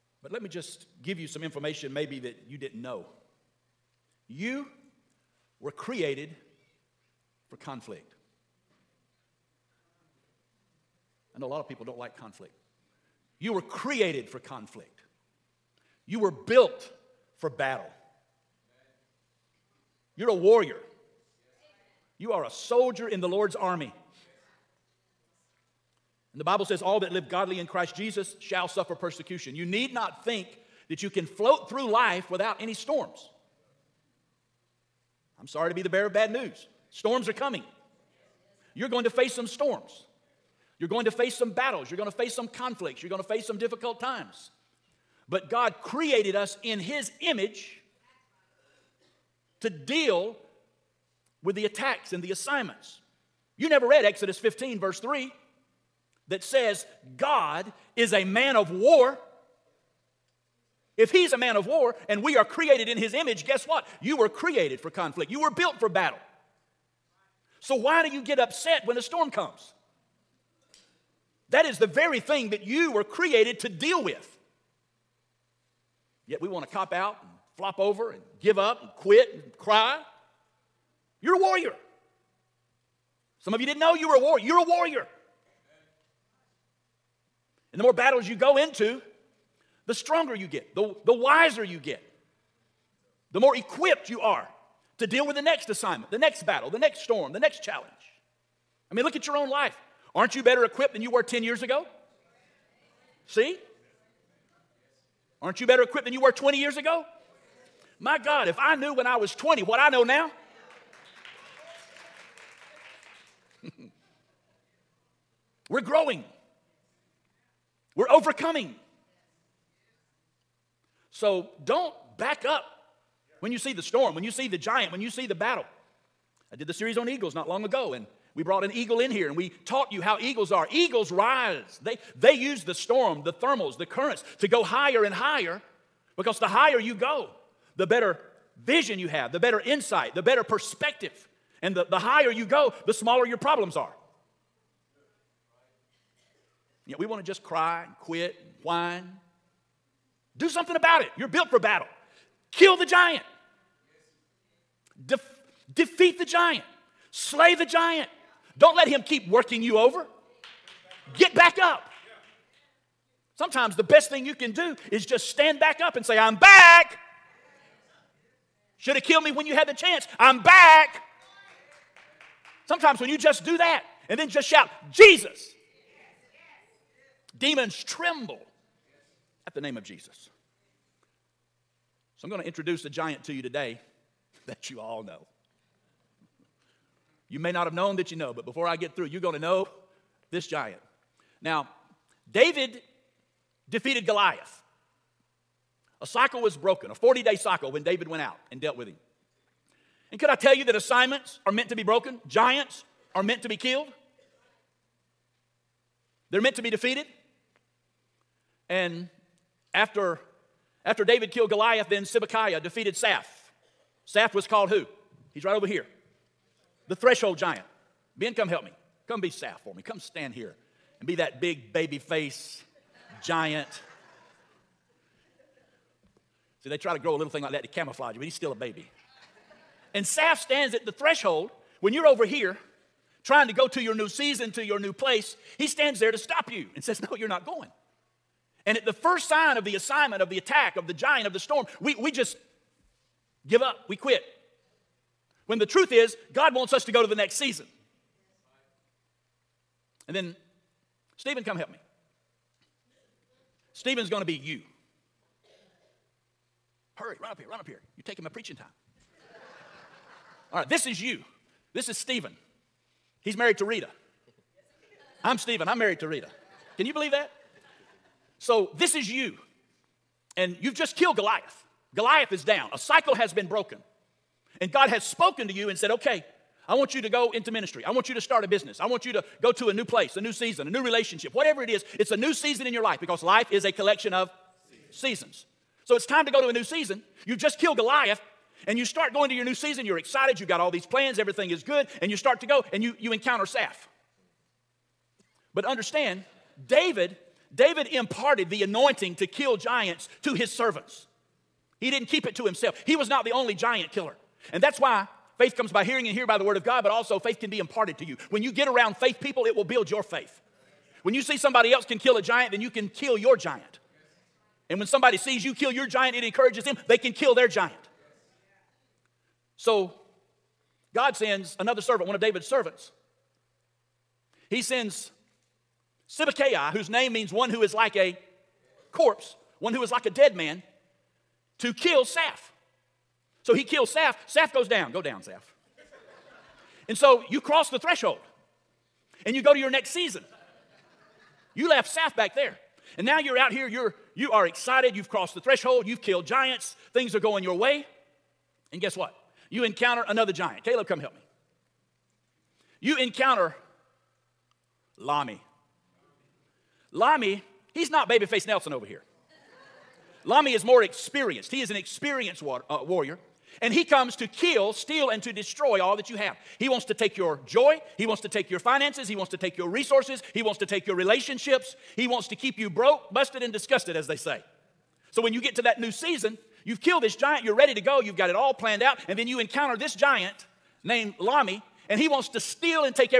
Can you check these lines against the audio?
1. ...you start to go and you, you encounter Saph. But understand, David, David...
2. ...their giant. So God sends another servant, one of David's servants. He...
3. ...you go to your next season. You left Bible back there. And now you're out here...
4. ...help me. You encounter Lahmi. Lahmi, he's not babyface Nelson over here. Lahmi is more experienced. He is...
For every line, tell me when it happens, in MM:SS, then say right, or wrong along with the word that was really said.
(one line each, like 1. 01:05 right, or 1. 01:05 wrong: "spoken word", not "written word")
1. 04:52 right
2. 05:17 right
3. 05:39 wrong: "Saph", not "Bible"
4. 05:50 right.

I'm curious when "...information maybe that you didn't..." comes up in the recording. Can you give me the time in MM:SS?
00:01.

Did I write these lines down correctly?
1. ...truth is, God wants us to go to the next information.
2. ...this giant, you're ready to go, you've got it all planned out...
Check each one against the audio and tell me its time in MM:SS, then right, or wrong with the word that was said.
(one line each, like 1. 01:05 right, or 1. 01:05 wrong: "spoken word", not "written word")
1. 04:05 wrong: "season", not "information"
2. 06:17 right.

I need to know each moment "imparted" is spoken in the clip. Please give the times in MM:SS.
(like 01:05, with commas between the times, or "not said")
04:57, 05:07.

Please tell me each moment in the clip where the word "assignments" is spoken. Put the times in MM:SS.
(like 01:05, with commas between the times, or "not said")
00:52, 01:35, 03:20, 03:59.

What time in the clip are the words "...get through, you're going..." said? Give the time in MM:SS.
03:08.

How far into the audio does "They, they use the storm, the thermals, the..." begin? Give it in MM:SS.
02:11.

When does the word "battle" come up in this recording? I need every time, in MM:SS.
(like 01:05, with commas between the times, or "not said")
00:17, 00:41, 01:05, 01:27, 01:36, 02:05, 02:31.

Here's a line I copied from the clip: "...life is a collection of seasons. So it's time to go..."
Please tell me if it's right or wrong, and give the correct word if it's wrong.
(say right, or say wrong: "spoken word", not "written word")
right.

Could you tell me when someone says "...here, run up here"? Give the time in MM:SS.
04:17.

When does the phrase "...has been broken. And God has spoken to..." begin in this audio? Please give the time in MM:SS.
04:33.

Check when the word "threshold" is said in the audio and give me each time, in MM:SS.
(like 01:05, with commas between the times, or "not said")
03:36, 03:50, 05:37, 05:45.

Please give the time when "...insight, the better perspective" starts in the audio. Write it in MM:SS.
02:19.